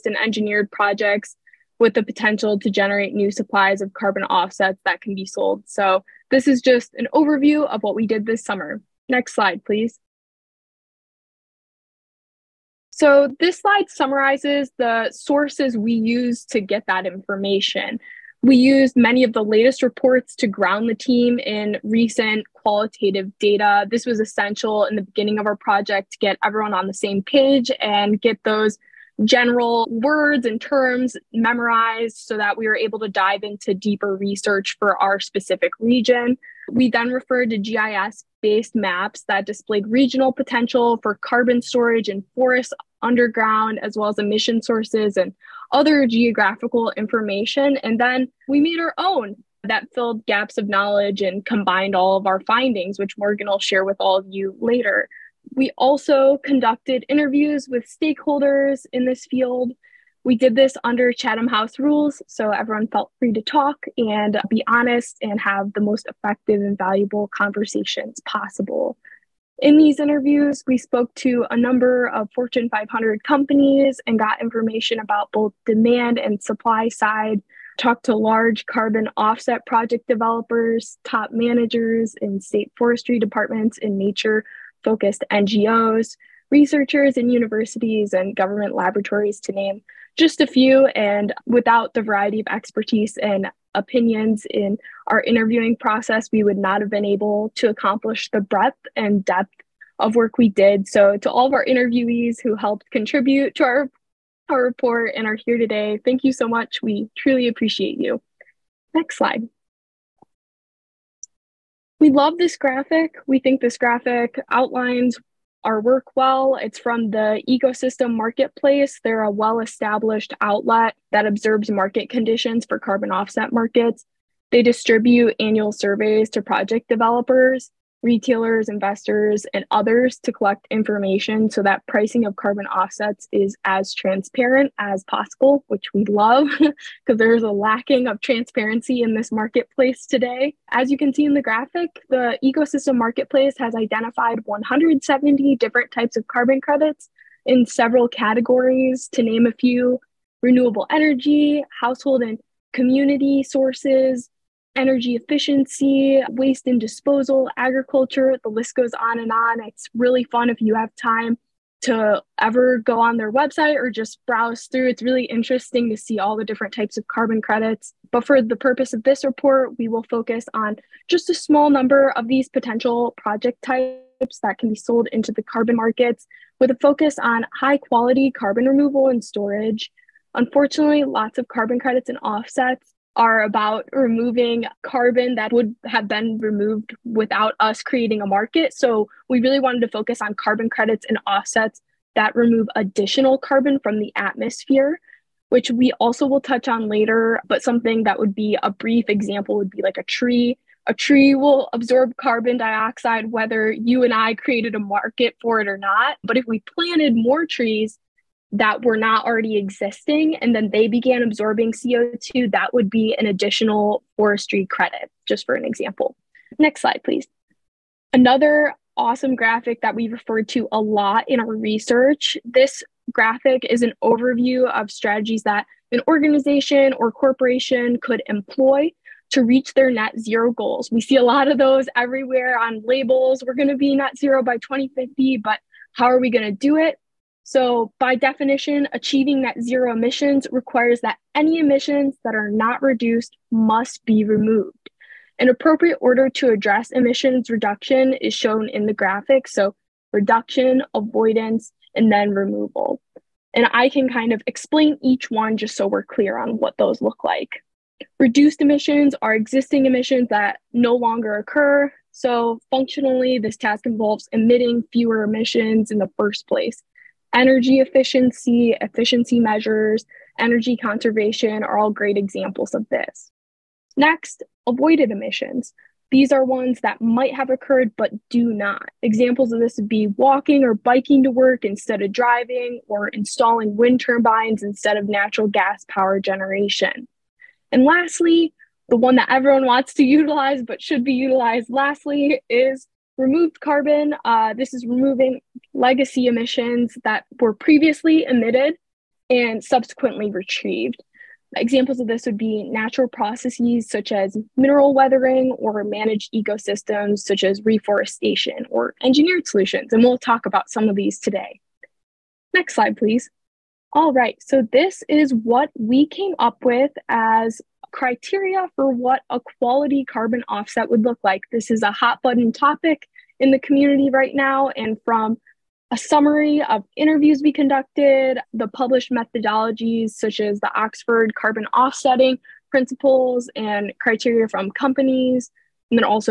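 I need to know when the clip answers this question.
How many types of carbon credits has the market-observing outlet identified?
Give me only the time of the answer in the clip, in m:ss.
2:24.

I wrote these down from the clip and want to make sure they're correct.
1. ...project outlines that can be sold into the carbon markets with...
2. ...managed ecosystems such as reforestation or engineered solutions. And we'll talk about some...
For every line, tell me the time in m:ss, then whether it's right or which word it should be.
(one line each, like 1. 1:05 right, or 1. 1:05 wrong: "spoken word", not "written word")
1. 2:53 wrong: "types", not "outlines"
2. 5:05 right.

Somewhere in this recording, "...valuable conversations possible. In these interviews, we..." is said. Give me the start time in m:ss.
1:06.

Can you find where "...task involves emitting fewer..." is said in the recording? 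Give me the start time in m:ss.
4:23.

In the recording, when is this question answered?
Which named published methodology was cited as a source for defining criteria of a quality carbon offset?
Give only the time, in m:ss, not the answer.
5:30.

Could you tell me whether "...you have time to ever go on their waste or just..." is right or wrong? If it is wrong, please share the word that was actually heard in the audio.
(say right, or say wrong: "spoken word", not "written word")
wrong: "website", not "waste".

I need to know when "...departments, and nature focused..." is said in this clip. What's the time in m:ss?
1:23.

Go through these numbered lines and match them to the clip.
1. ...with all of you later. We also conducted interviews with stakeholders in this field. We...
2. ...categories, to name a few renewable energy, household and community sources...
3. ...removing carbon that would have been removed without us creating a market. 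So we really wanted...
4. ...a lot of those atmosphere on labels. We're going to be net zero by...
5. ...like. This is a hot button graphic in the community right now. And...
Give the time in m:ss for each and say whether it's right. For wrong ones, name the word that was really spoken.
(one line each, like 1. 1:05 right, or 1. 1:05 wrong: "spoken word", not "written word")
1. 0:53 right
2. 2:28 right
3. 3:03 right
4. 3:51 wrong: "everywhere", not "atmosphere"
5. 5:21 wrong: "topic", not "graphic".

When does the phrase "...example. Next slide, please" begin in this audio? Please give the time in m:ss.
3:35.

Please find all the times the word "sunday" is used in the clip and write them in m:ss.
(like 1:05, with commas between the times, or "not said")
not said.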